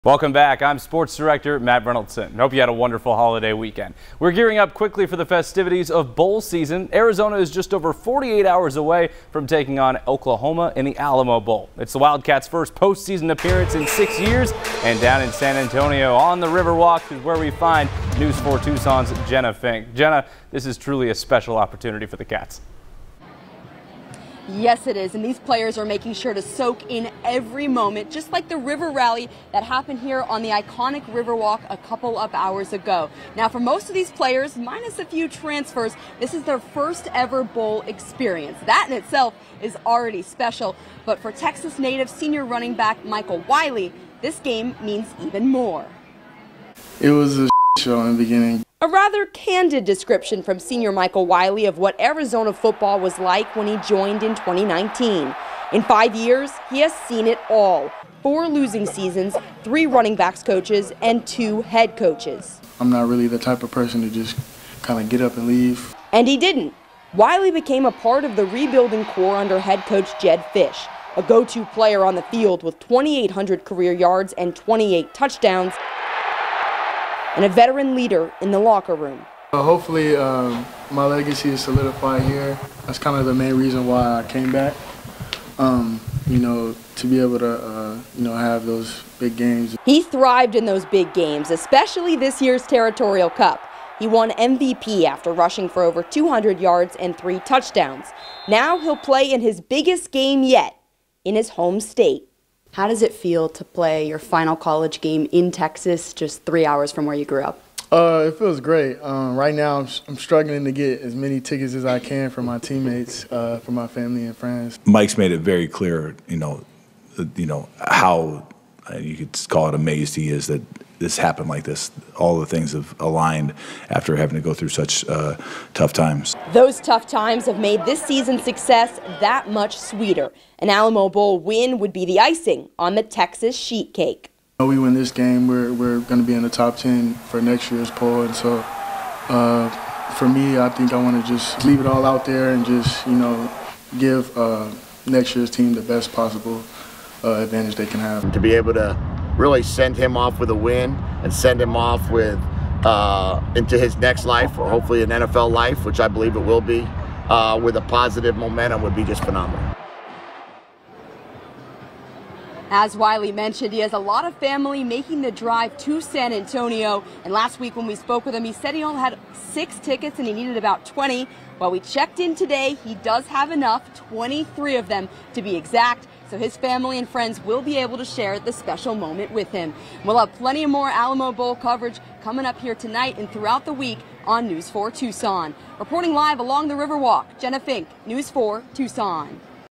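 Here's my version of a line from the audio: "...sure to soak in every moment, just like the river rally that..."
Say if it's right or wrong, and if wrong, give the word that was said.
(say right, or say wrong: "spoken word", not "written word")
right.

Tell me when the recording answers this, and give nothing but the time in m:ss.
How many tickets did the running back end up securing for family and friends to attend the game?
2:54.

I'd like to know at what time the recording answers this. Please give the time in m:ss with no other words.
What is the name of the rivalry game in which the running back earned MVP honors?
1:32.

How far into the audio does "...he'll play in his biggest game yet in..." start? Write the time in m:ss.
1:38.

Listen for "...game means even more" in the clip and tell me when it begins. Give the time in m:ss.
0:44.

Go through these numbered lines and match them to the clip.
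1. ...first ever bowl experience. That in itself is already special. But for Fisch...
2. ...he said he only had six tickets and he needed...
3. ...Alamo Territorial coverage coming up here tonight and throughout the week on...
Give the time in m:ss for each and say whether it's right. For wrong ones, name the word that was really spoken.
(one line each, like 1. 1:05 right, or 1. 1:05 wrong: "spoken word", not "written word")
1. 0:36 wrong: "Texas", not "Fisch"
2. 2:48 right
3. 3:00 wrong: "Bowl", not "Territorial".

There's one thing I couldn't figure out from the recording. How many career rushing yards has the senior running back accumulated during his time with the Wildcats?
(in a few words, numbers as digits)
2,800.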